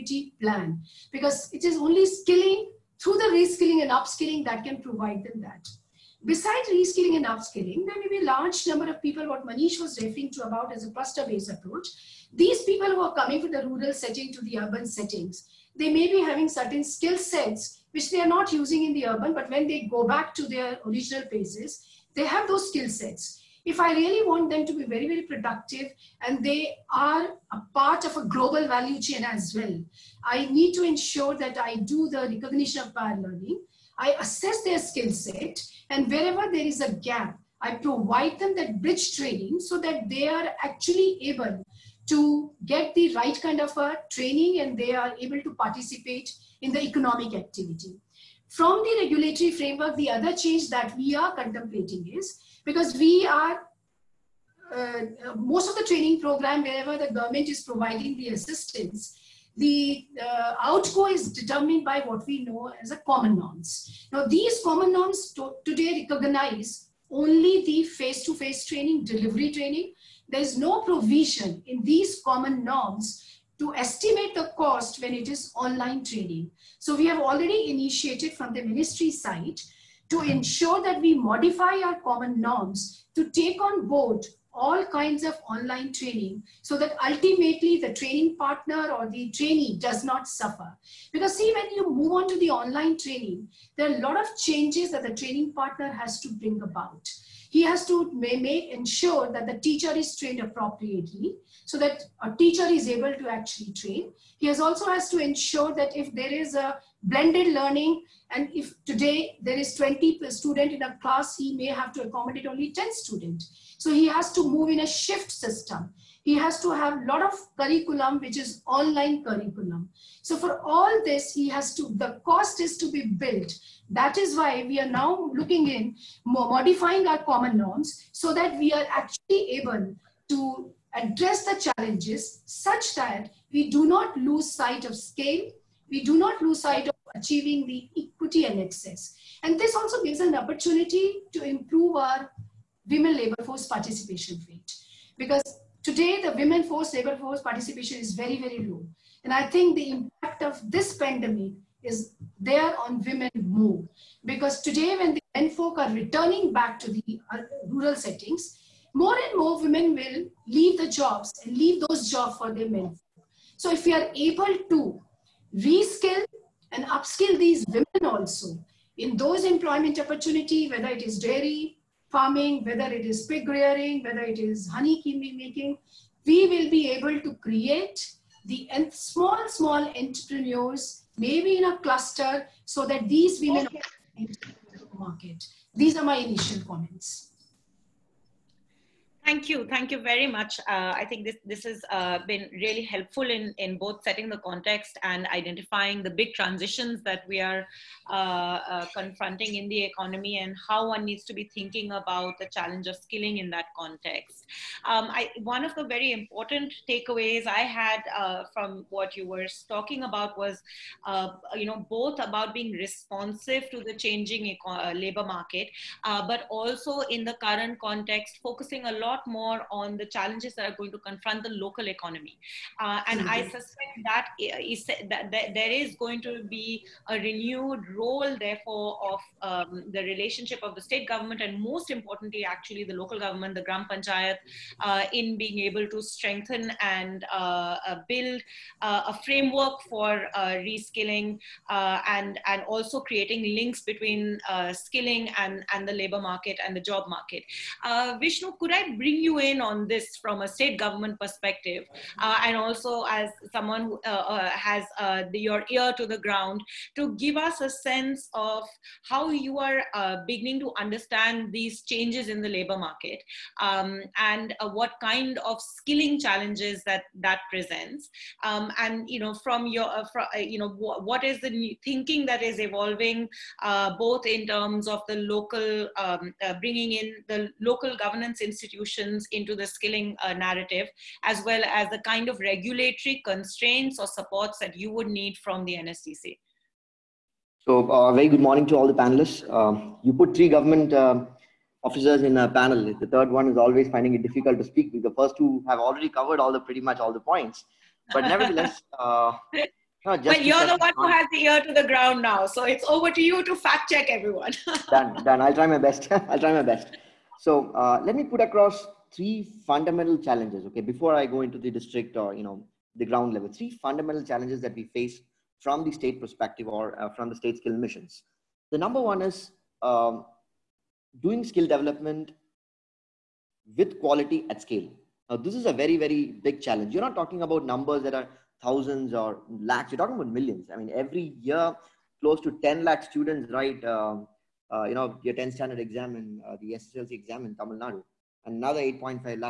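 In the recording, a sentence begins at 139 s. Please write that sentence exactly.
And this also gives an opportunity to improve our women labor force participation rate.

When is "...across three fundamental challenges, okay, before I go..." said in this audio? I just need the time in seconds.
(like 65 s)
308 s.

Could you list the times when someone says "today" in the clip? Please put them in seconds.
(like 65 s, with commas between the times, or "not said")
65 s, 108 s, 145 s, 154 s.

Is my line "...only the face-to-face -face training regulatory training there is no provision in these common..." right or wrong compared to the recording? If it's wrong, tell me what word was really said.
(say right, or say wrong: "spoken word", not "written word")
wrong: "delivery", not "regulatory".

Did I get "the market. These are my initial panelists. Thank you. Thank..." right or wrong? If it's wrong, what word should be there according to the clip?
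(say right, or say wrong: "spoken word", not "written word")
wrong: "comments", not "panelists".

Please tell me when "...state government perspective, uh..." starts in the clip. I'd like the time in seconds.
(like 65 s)
250 s.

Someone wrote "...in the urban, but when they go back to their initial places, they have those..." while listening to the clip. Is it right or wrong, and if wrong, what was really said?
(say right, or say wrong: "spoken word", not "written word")
wrong: "original", not "initial".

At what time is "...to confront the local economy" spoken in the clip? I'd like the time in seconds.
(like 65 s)
220 s.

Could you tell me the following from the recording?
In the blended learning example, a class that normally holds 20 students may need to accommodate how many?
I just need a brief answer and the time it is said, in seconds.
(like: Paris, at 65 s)
10, at 112 s.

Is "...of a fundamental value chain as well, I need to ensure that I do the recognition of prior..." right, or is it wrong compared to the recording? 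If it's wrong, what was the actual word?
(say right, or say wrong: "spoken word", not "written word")
wrong: "global", not "fundamental".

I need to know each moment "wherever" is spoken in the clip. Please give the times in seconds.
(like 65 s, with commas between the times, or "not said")
36 s, 56 s.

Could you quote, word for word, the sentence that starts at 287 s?
So, uh, very good morning to all the panelists.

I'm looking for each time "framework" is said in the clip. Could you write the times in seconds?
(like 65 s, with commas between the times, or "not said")
49 s, 239 s.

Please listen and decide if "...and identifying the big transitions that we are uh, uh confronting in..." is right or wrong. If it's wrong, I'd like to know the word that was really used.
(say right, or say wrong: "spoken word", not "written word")
right.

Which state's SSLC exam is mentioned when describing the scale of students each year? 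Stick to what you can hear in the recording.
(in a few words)
Tamil Nadu.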